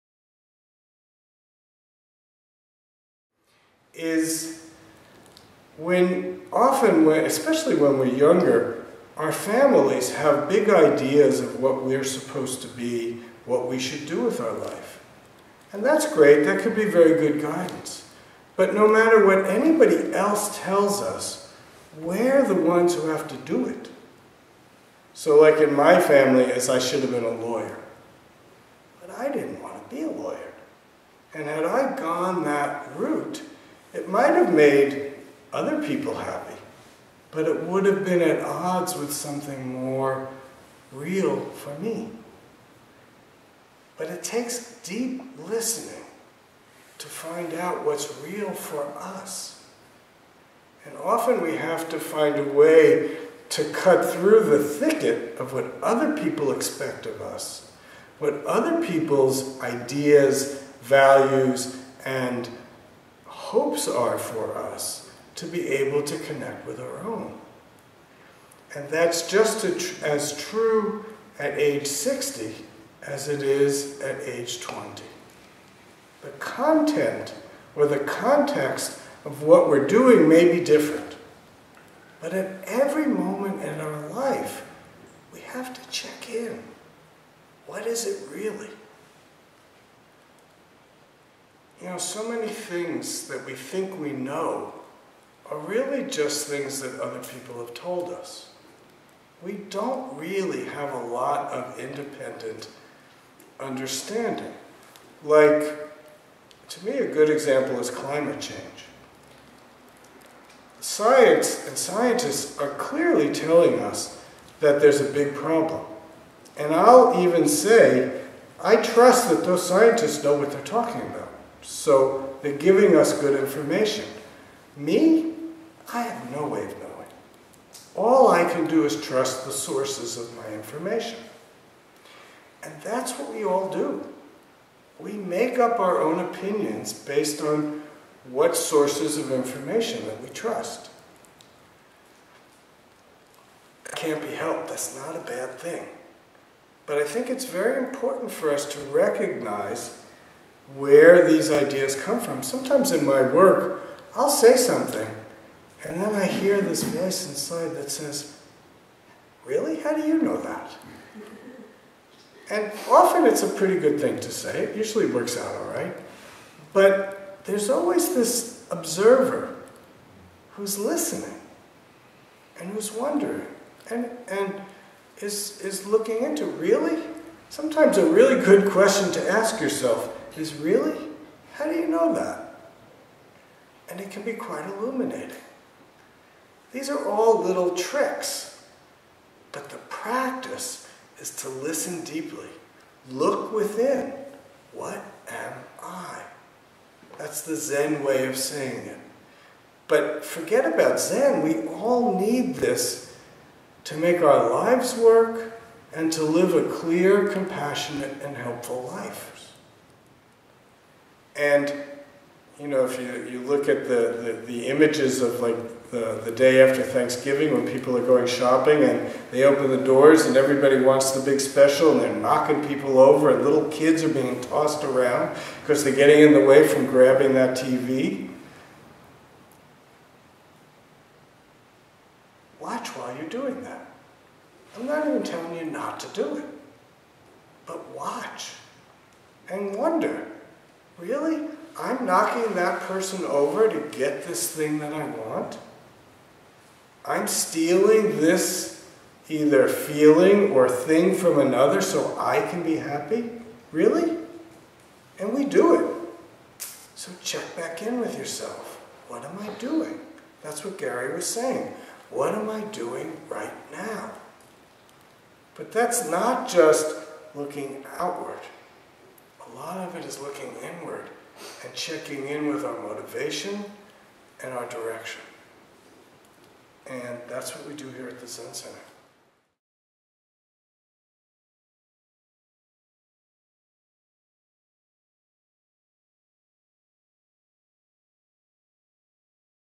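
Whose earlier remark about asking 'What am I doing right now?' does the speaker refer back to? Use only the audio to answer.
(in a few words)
Gary.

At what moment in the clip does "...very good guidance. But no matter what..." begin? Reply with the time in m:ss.
0:16.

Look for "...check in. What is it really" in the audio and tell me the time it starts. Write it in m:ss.
1:25.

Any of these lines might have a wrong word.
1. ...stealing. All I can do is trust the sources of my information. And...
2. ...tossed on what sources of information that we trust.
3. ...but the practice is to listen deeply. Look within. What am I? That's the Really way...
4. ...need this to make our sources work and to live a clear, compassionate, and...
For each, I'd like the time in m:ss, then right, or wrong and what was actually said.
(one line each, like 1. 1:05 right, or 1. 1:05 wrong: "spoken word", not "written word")
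1. 2:06 wrong: "knowing", not "stealing"
2. 2:16 wrong: "based", not "tossed"
3. 3:09 wrong: "Zen", not "Really"
4. 3:22 wrong: "lives", not "sources".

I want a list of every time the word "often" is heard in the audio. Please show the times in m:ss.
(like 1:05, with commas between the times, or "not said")
0:06, 0:50, 2:42.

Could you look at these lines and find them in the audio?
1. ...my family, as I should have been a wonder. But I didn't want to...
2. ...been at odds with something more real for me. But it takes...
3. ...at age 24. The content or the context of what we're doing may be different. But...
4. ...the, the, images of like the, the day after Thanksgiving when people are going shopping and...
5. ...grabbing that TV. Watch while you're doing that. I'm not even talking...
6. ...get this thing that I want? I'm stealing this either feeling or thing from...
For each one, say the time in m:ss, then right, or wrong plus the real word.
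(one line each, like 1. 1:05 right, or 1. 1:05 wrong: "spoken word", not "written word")
1. 0:25 wrong: "lawyer", not "wonder"
2. 0:38 right
3. 1:14 wrong: "20", not "24"
4. 3:34 right
5. 3:46 wrong: "telling", not "talking"
6. 4:03 right.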